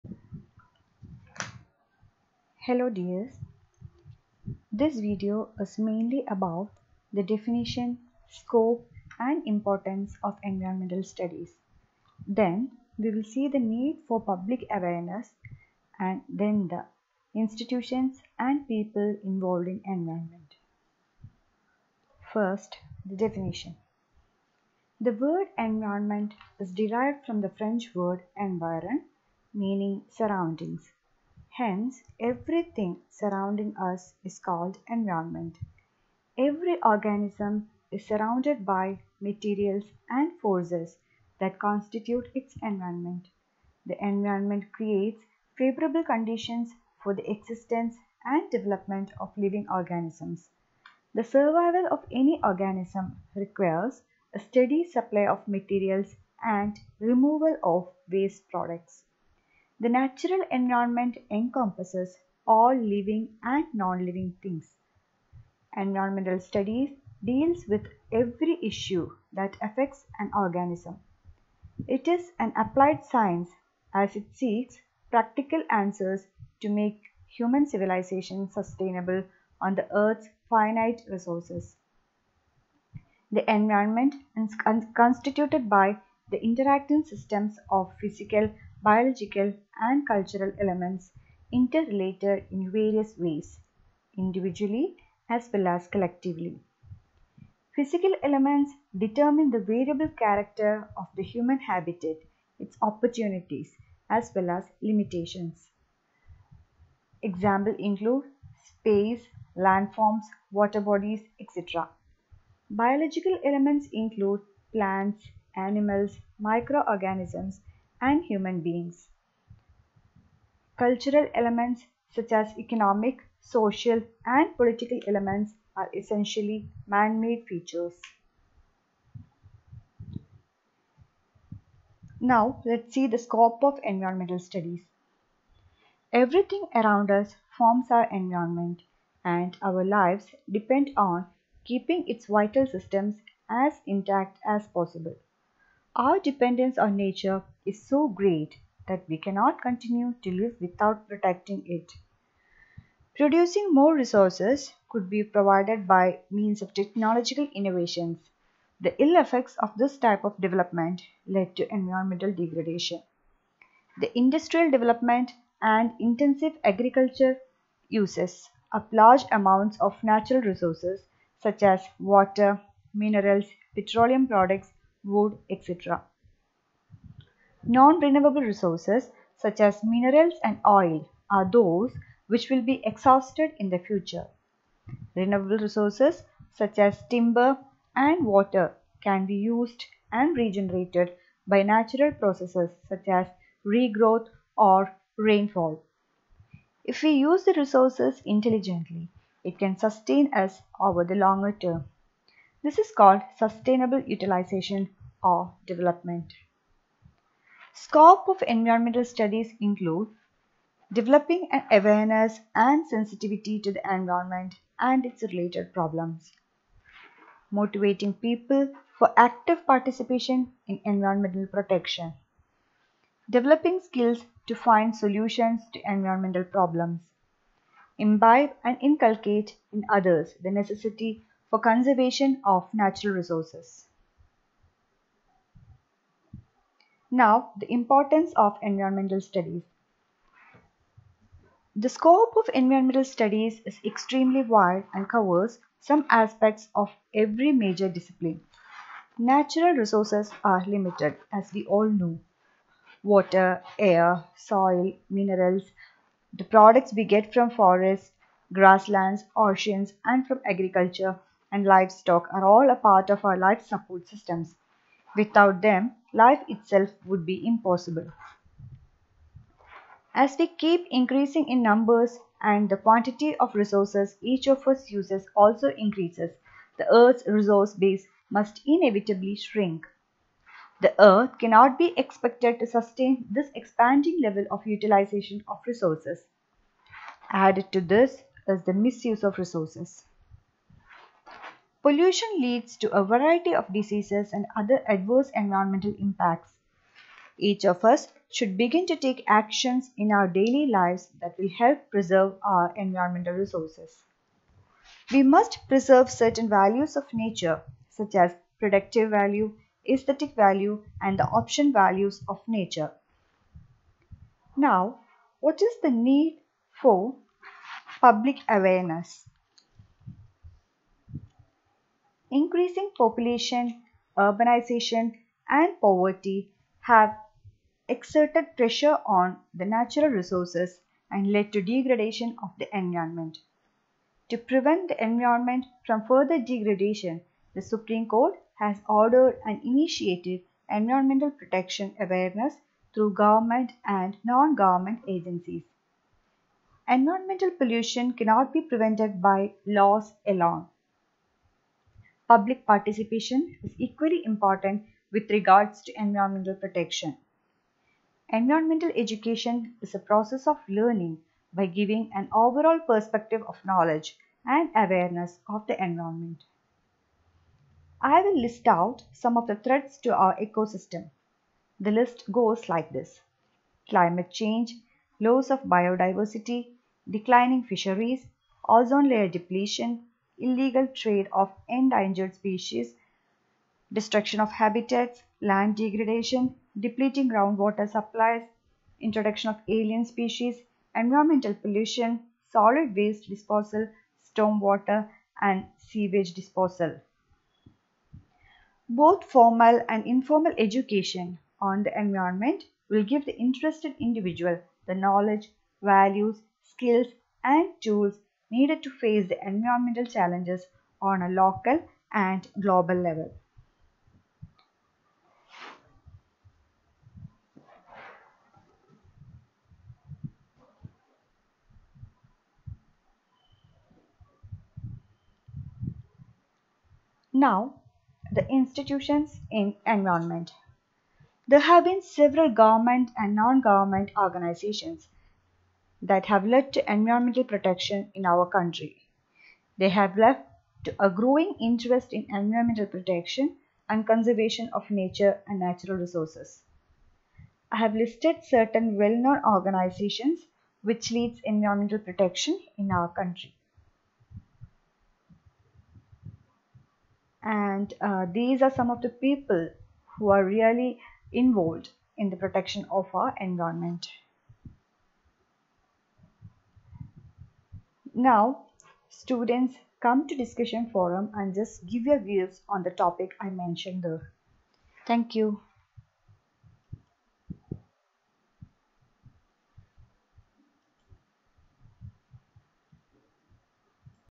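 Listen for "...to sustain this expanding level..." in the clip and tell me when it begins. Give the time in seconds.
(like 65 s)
282 s.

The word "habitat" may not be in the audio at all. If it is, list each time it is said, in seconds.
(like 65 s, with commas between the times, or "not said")
101 s, 384 s.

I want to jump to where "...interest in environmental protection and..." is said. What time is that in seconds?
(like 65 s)
441 s.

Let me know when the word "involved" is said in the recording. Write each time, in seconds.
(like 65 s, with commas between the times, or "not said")
19 s, 461 s.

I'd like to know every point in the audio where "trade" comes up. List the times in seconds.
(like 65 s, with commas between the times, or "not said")
380 s.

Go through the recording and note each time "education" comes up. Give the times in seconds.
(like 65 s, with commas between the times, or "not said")
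359 s, 400 s.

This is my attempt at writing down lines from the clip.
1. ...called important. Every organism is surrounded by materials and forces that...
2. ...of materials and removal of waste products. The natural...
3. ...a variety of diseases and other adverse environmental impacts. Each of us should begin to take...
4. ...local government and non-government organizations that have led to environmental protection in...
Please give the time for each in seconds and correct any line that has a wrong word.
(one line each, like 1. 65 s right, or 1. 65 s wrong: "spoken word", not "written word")
1. 34 s wrong: "environment", not "important"
2. 55 s right
3. 292 s right
4. 432 s wrong: "several", not "local".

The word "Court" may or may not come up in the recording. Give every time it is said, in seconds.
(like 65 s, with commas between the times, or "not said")
338 s.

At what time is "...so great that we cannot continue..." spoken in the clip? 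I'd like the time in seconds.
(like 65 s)
147 s.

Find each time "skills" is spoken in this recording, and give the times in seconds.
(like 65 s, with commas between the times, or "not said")
223 s, 406 s.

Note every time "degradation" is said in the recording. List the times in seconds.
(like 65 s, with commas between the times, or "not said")
162 s, 331 s, 336 s, 385 s.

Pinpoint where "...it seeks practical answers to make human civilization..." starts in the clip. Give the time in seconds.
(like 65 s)
74 s.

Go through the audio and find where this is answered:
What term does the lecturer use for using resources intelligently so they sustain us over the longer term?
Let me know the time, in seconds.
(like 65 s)
203 s.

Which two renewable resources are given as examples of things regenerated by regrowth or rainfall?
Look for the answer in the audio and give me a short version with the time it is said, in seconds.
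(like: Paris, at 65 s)
Timber and water, at 187 s.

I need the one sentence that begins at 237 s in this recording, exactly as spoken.
Now, the importance of environmental studies.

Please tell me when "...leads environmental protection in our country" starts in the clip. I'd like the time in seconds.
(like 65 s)
451 s.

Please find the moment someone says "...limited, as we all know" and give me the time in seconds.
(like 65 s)
250 s.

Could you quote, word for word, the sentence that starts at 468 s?
Now, students come to discussion forum and just give your views on the topic I mentioned there.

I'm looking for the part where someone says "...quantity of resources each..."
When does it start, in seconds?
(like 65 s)
272 s.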